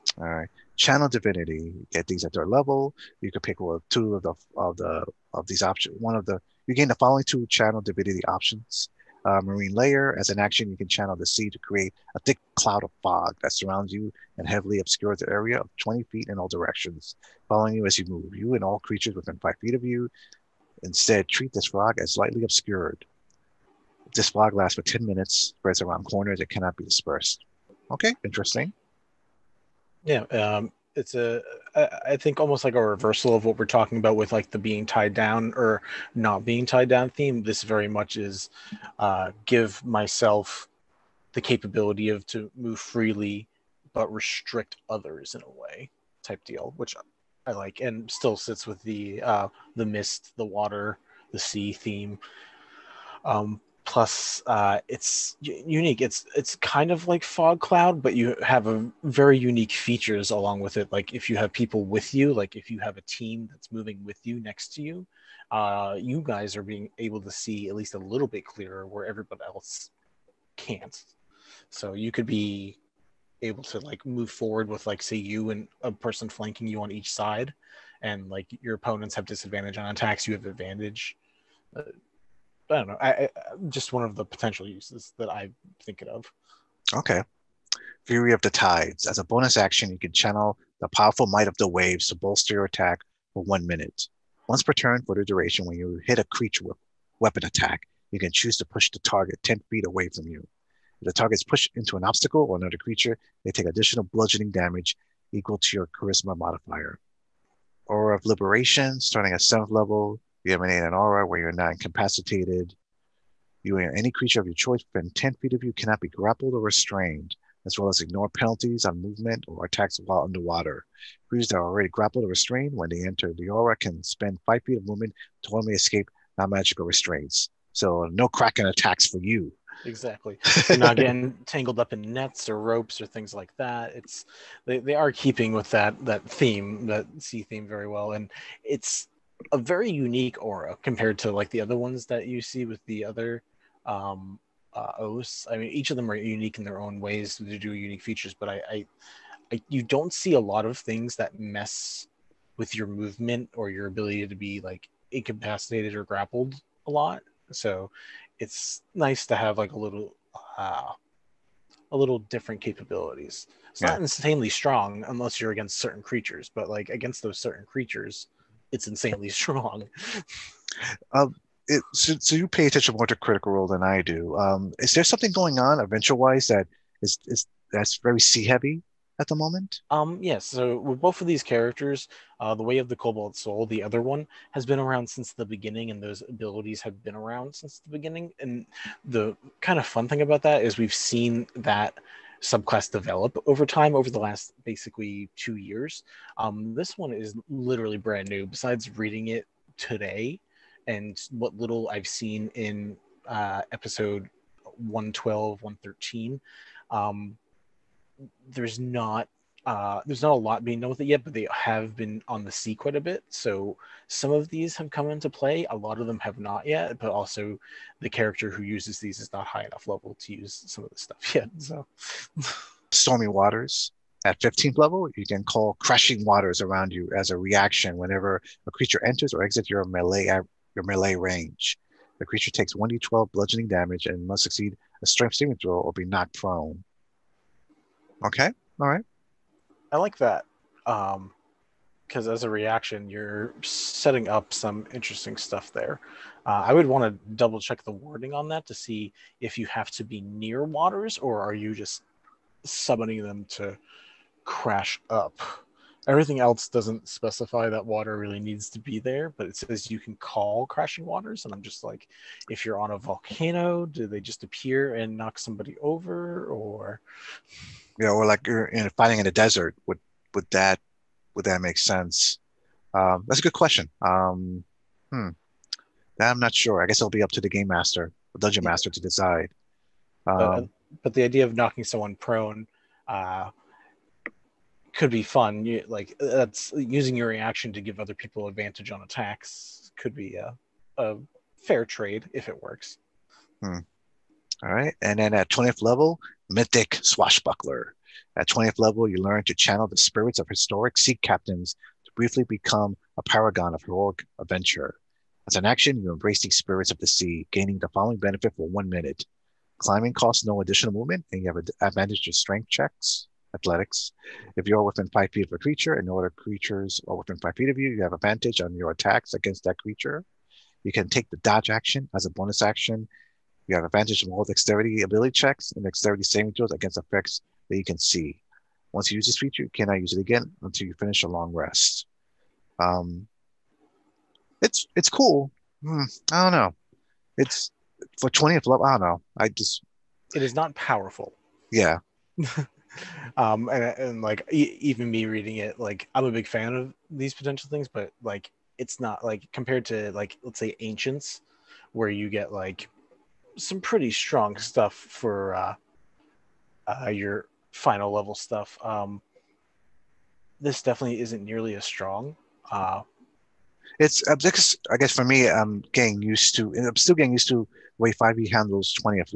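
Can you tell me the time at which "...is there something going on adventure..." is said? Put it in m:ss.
2:54.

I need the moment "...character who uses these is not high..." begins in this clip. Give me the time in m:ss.
3:38.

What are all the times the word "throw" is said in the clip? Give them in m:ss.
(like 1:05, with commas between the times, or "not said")
3:55, 5:26.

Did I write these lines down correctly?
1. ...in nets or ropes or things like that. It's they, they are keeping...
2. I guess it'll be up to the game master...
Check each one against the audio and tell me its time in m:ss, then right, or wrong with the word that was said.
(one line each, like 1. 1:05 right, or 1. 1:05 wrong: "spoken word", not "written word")
1. 2:11 right
2. 4:36 right.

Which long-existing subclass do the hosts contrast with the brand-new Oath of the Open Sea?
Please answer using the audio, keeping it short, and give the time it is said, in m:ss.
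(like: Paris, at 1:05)
Way of the Cobalt Soul, at 3:02.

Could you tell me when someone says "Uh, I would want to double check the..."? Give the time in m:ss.
4:06.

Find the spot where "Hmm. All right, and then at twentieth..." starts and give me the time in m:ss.
4:53.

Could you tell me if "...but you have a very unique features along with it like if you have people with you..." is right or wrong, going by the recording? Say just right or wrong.
right.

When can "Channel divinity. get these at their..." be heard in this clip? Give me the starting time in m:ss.
0:00.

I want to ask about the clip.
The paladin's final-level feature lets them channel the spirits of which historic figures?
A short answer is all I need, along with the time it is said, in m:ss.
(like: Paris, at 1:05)
sea captains, at 5:00.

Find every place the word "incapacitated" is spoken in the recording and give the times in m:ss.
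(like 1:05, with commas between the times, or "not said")
1:51, 2:35.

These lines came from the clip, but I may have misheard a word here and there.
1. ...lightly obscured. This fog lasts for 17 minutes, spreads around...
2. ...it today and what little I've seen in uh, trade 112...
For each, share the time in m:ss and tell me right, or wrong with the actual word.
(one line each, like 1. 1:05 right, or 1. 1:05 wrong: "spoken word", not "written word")
1. 0:22 wrong: "10", not "17"
2. 3:19 wrong: "episode", not "trade".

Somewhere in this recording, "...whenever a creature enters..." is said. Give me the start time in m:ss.
3:47.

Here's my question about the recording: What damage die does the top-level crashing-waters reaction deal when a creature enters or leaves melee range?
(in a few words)
1d12.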